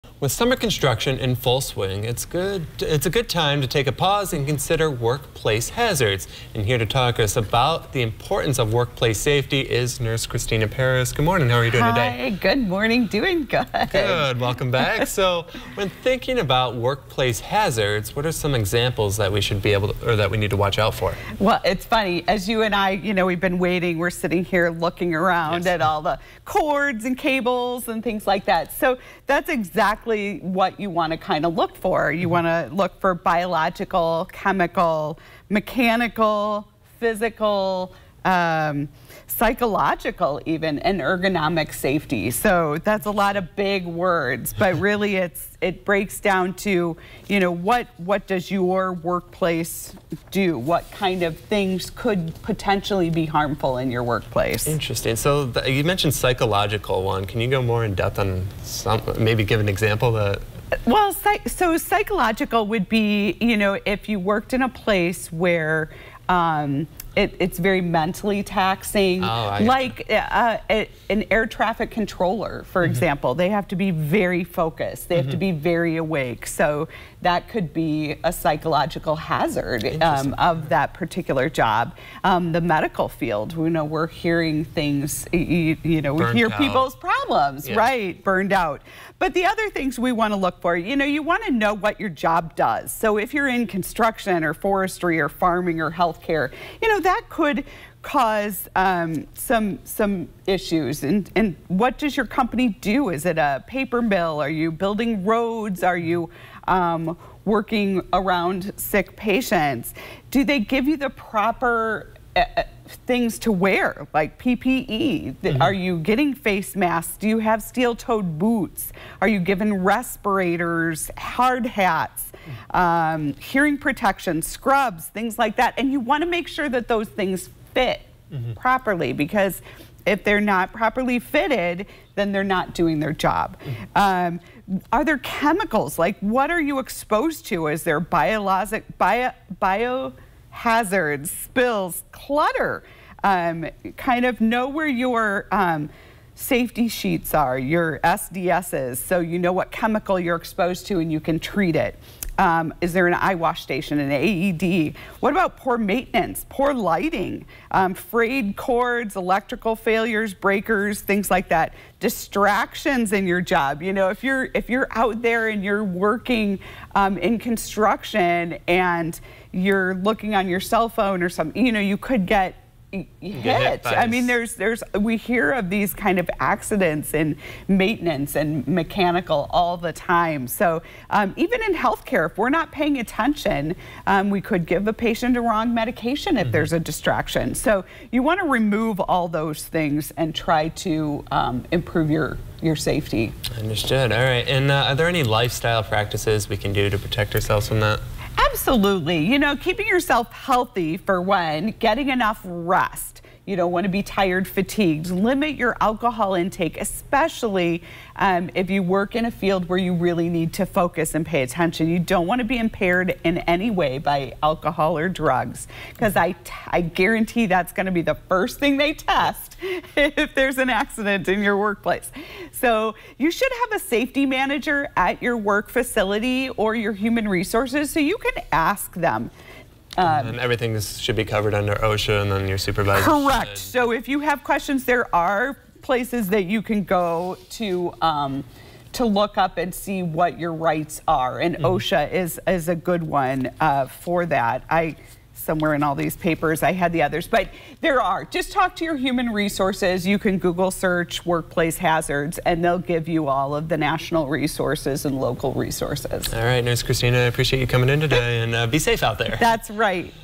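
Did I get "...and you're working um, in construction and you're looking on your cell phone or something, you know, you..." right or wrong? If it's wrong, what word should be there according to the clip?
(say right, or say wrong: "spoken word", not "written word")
right.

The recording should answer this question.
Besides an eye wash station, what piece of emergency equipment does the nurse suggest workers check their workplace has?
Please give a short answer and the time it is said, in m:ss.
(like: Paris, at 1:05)
AED, at 2:34.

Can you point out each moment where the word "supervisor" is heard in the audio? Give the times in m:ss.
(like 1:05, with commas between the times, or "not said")
3:52.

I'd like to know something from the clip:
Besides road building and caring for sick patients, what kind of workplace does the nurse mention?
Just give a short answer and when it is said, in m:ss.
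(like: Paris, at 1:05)
paper mill, at 1:43.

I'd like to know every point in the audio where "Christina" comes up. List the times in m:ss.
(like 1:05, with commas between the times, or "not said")
0:10, 4:16.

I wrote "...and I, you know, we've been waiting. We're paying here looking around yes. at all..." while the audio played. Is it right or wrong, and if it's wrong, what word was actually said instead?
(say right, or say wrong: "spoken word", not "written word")
wrong: "sitting", not "paying".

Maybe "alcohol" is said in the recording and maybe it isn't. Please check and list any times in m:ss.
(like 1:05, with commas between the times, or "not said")
3:25, 3:34.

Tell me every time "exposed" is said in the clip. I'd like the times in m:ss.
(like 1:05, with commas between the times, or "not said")
2:16, 2:30.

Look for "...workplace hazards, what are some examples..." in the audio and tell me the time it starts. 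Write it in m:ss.
0:16.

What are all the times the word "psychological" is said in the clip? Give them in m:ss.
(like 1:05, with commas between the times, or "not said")
0:39, 0:56, 1:01, 1:18.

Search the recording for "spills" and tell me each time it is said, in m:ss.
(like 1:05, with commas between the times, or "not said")
2:21.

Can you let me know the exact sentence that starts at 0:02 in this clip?
It's a good time to take a pause and consider workplace hazards.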